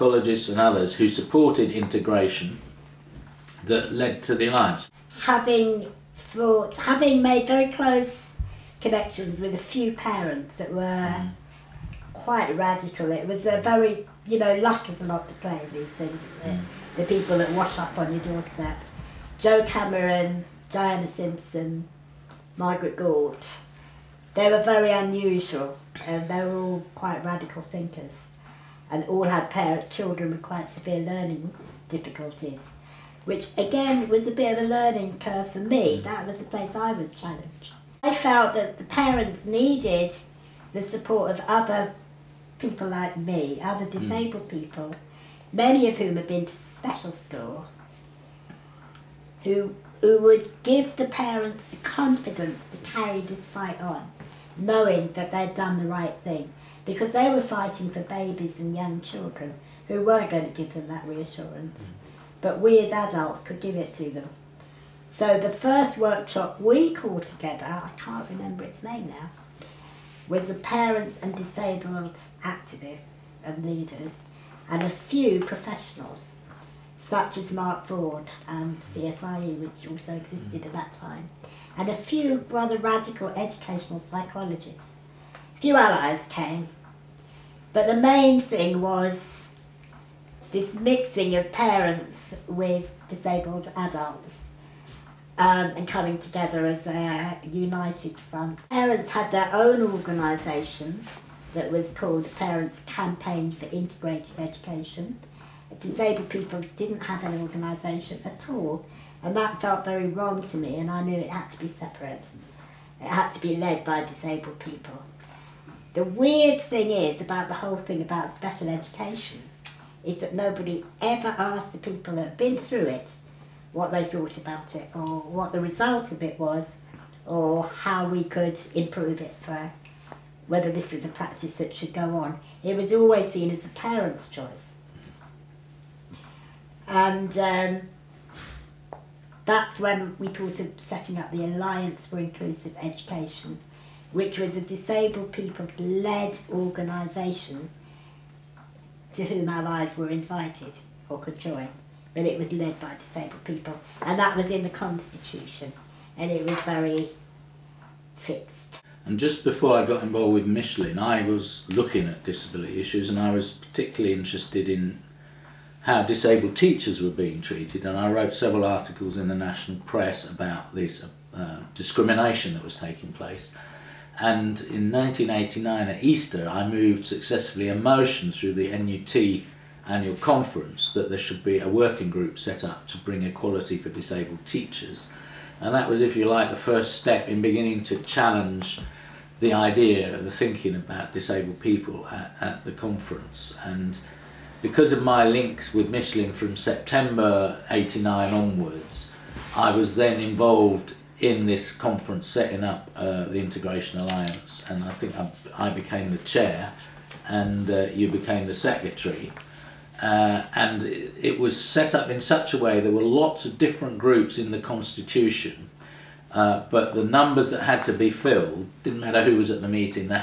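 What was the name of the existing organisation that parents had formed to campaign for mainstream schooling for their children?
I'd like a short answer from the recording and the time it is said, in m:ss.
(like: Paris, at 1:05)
Parents Campaign for Integrated Education, at 1:42.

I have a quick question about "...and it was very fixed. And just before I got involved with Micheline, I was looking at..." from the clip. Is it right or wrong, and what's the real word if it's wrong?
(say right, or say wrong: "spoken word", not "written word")
right.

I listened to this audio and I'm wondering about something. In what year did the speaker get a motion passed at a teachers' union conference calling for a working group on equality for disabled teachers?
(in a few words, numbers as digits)
1989.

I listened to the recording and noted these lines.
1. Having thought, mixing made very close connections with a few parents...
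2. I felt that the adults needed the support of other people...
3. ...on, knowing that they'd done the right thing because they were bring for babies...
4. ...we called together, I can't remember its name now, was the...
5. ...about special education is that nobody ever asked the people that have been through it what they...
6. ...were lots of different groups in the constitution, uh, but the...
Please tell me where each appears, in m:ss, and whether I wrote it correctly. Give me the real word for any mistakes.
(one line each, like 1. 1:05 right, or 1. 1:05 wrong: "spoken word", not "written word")
1. 0:05 wrong: "having", not "mixing"
2. 0:38 wrong: "parents", not "adults"
3. 0:53 wrong: "fighting", not "bring"
4. 1:06 right
5. 1:58 right
6. 3:32 right.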